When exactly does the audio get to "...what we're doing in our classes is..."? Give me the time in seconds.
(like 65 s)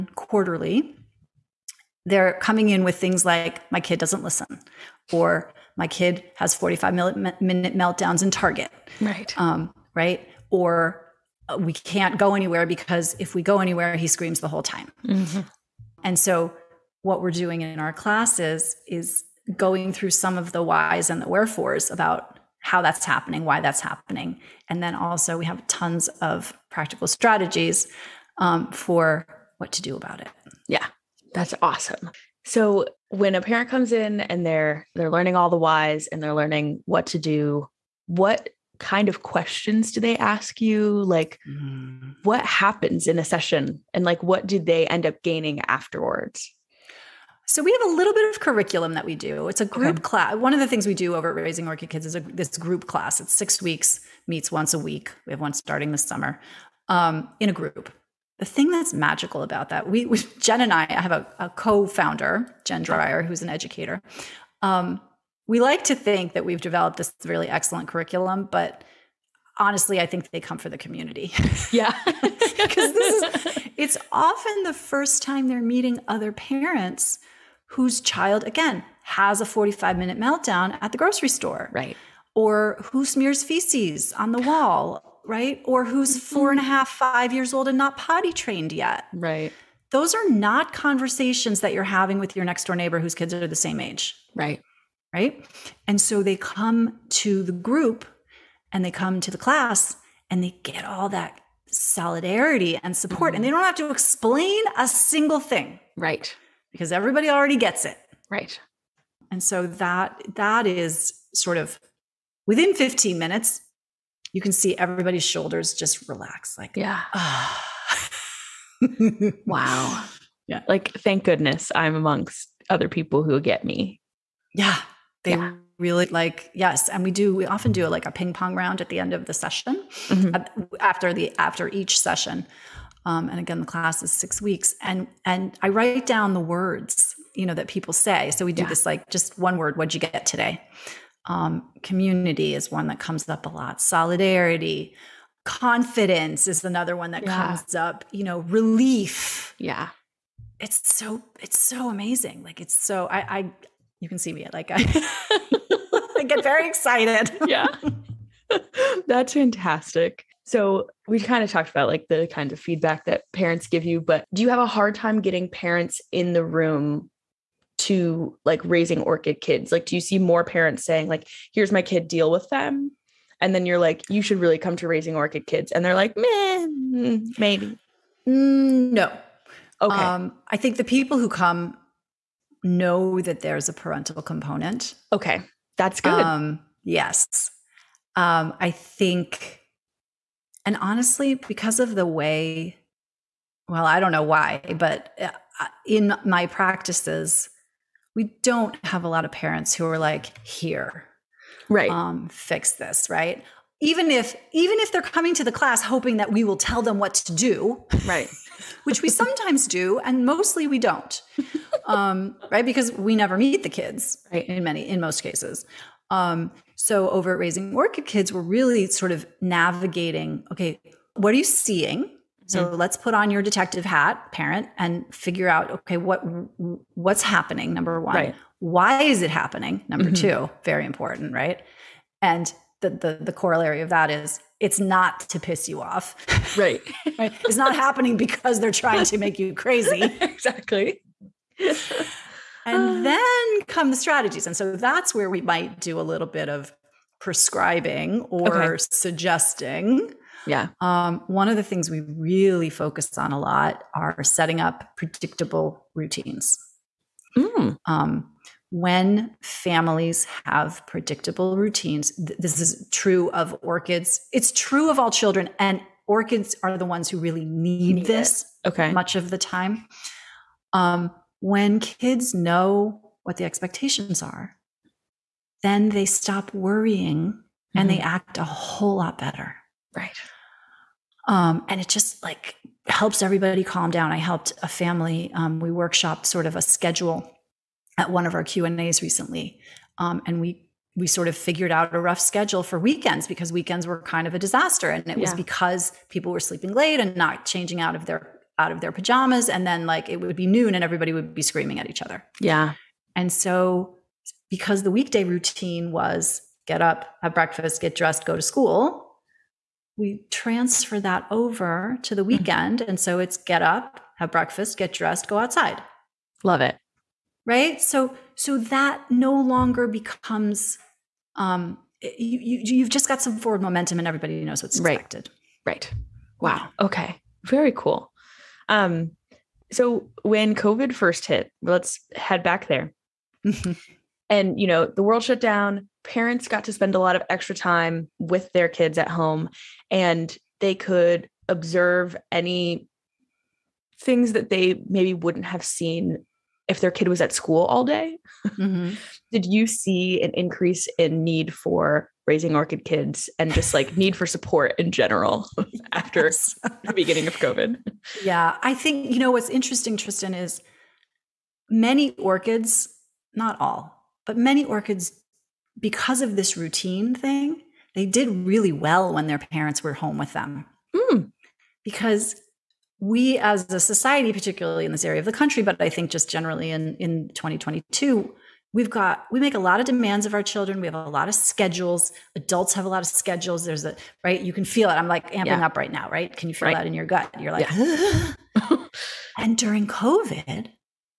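17 s.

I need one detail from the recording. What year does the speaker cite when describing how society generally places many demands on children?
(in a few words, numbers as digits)
2022.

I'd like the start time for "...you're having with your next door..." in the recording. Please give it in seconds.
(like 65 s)
91 s.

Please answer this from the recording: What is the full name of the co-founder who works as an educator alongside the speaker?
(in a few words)
Jen Dreyer.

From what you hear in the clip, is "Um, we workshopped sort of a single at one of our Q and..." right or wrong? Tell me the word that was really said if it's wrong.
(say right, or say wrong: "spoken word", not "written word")
wrong: "schedule", not "single".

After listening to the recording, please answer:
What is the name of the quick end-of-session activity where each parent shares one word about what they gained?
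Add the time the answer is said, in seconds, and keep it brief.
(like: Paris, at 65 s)
ping pong round, at 128 s.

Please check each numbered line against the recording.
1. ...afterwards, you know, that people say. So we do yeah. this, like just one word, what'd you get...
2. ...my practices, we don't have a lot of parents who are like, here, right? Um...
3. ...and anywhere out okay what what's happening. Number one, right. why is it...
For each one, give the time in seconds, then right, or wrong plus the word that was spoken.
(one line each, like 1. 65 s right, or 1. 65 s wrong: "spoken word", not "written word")
1. 136 s wrong: "words", not "afterwards"
2. 196 s right
3. 224 s wrong: "figure", not "anywhere".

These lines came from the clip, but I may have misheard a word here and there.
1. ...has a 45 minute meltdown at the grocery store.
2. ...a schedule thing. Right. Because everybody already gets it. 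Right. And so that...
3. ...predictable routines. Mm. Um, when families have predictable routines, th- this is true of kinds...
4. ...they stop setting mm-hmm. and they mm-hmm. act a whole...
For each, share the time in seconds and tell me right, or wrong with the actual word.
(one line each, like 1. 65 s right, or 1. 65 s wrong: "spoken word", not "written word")
1. 79 s right
2. 104 s wrong: "single", not "schedule"
3. 254 s wrong: "orchids", not "kinds"
4. 275 s wrong: "worrying", not "setting".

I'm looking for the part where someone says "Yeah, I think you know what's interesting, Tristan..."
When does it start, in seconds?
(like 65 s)
358 s.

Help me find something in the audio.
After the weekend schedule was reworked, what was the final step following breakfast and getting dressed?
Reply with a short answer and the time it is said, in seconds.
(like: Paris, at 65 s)
go outside, at 315 s.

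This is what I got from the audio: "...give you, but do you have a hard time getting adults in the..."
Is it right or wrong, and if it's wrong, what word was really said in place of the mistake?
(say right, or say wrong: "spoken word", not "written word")
wrong: "parents", not "adults".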